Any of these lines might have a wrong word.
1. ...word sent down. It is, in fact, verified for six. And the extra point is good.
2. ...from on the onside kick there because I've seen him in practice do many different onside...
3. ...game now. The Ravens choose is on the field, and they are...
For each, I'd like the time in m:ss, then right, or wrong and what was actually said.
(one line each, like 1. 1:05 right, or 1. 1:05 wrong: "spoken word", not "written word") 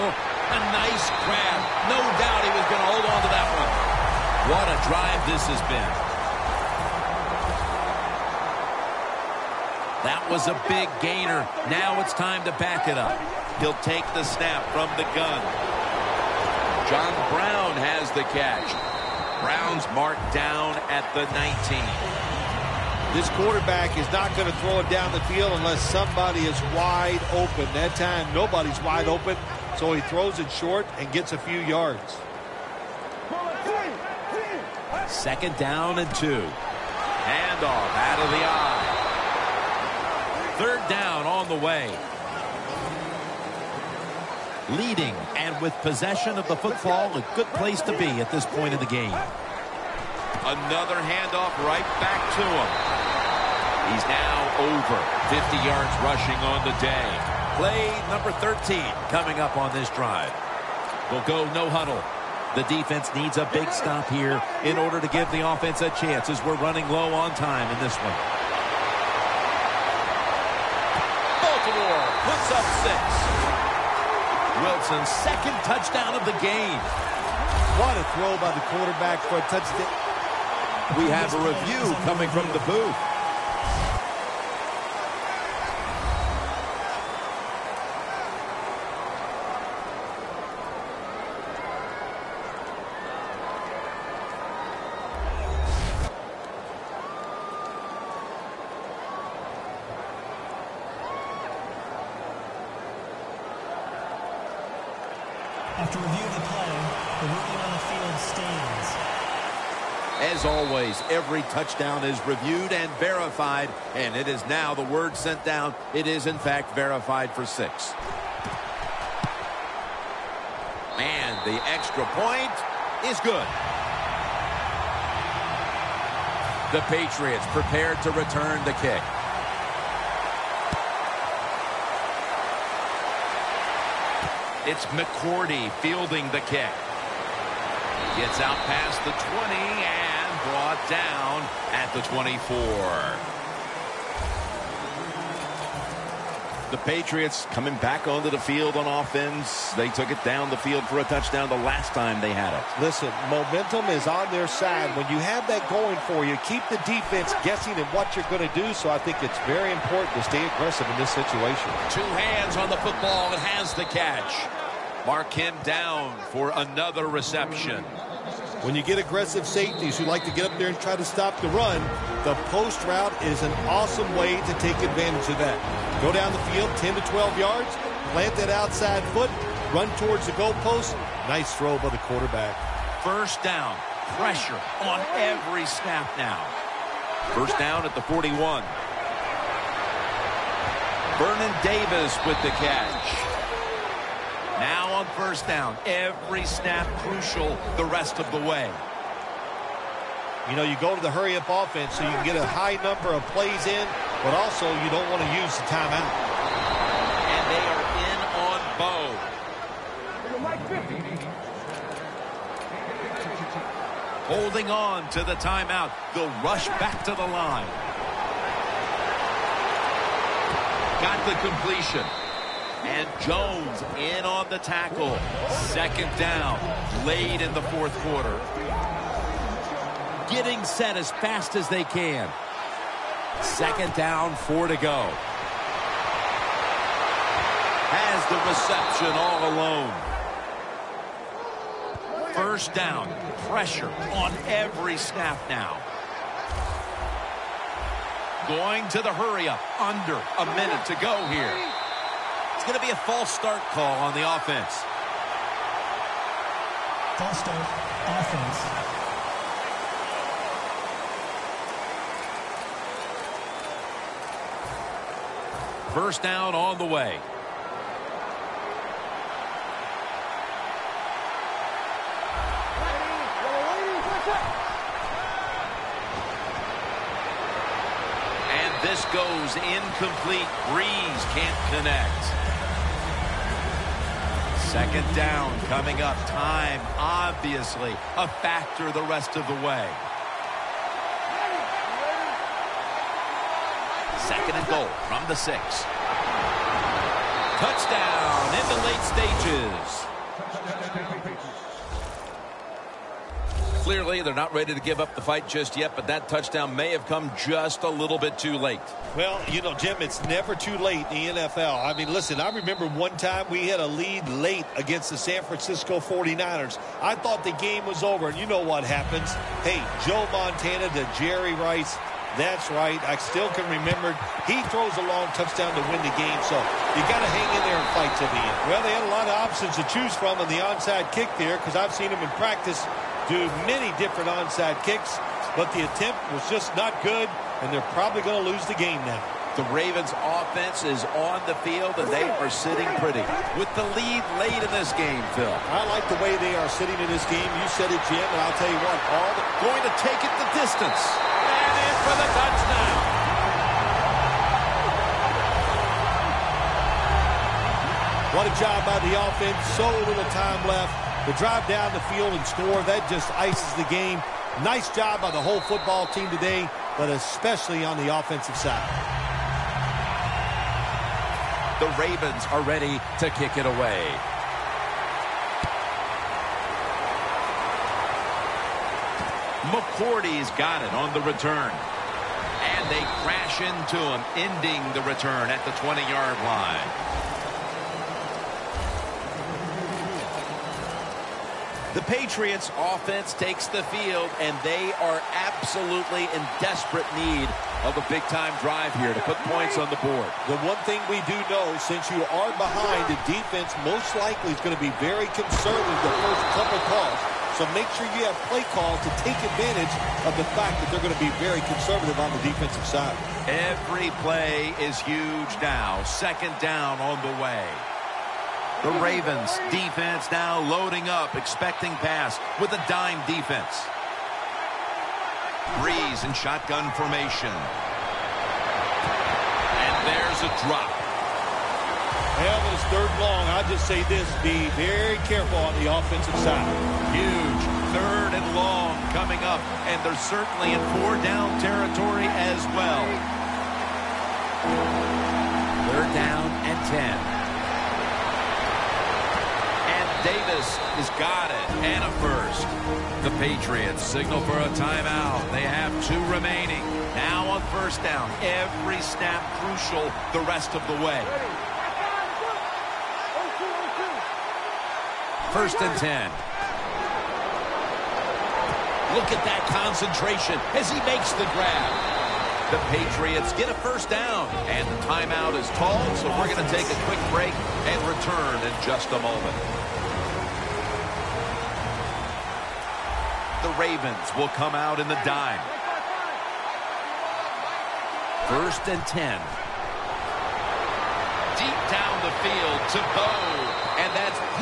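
1. 1:54 right
2. 5:30 right
3. 5:38 wrong: "offense", not "choose".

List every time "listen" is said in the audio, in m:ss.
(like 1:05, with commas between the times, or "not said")
2:32, 5:12.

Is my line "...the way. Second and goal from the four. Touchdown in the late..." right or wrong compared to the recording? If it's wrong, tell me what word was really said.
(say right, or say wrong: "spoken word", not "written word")
wrong: "six", not "four".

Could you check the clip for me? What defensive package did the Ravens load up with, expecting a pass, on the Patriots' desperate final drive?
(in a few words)
dime defense.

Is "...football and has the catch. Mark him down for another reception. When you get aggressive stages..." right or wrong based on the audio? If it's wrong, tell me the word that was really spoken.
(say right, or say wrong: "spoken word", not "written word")
wrong: "safeties", not "stages".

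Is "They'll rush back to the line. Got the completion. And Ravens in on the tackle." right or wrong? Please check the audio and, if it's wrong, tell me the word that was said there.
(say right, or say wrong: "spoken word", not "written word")
wrong: "Jones", not "Ravens".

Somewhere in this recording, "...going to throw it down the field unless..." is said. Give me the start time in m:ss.
0:24.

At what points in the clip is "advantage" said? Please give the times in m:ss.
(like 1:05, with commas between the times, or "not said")
2:54, 6:49.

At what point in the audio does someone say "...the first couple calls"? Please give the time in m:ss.
6:46.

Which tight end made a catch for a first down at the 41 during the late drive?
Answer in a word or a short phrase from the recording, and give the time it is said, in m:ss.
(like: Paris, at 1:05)
Vernon Davis, at 3:11.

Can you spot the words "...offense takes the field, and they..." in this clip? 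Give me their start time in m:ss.
6:32.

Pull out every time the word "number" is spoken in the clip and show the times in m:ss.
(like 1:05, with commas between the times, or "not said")
0:58, 3:22.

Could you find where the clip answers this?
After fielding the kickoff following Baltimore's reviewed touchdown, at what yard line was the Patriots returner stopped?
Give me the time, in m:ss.
2:22.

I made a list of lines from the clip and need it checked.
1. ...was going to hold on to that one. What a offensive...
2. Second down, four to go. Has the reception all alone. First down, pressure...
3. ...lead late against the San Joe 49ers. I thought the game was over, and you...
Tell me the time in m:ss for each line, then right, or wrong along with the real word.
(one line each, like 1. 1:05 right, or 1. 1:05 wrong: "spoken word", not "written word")
1. 0:02 wrong: "drive", not "offensive"
2. 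3:53 right
3. 5:13 wrong: "Francisco", not "Joe".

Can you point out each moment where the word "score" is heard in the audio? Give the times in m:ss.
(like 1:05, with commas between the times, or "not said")
6:02.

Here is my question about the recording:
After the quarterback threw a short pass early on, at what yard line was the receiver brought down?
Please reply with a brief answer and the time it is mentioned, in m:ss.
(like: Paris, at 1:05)
19, at 0:21.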